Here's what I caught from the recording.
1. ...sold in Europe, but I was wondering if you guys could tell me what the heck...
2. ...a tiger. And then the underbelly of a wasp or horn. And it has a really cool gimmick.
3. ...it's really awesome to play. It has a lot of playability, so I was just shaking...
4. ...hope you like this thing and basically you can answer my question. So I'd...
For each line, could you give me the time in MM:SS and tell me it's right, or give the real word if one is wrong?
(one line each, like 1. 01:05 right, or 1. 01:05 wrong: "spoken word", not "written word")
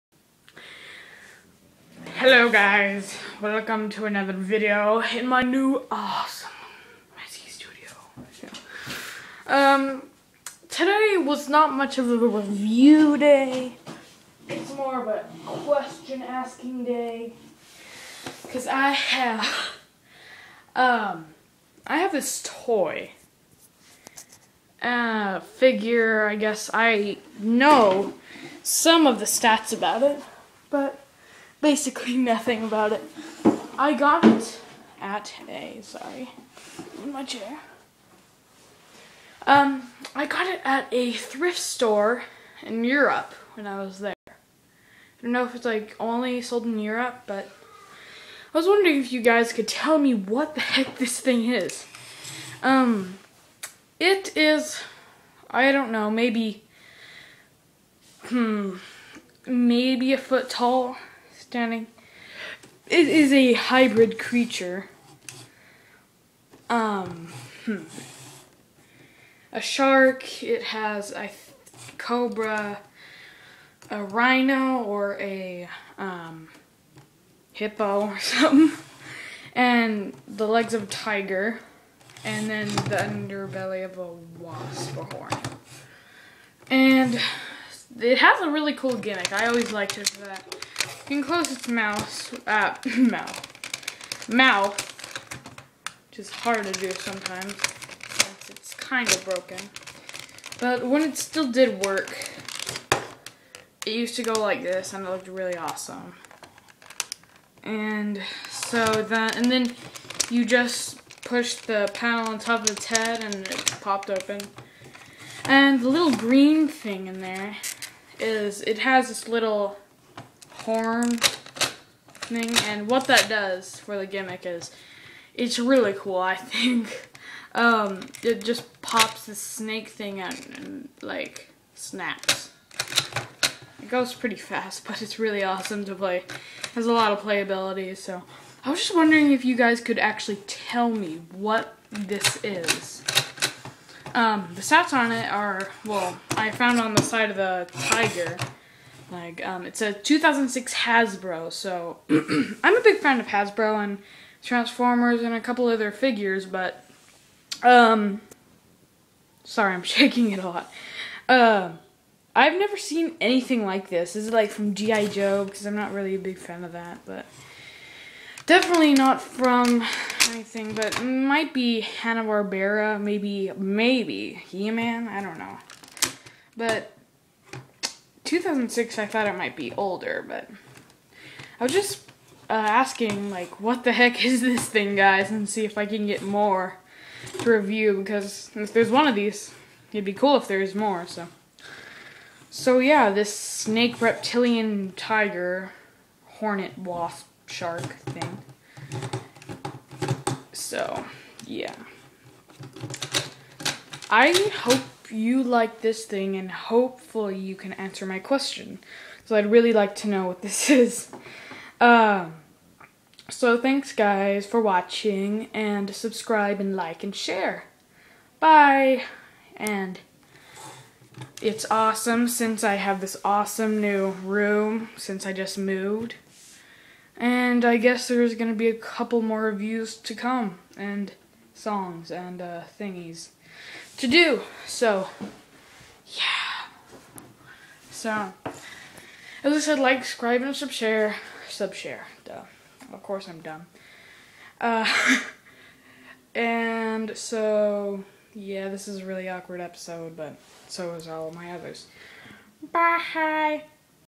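1. 00:46 right
2. 01:20 right
3. 02:15 wrong: "wondering", not "shaking"
4. 03:24 wrong: "hopefully", not "basically".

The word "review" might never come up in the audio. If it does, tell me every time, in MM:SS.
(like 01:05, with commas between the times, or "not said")
00:12, 03:07, 03:49.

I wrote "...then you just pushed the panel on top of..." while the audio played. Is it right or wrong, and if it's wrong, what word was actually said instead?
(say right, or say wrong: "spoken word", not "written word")
right.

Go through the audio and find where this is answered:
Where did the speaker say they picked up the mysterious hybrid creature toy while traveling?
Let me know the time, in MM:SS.
00:41.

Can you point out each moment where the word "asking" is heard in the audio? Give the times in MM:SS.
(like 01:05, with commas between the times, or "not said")
00:16, 03:02.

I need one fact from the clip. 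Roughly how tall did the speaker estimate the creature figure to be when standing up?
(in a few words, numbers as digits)
A foot.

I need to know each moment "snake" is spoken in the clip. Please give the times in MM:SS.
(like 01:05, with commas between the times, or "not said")
02:09, 03:13.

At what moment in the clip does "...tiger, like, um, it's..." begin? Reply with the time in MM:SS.
02:27.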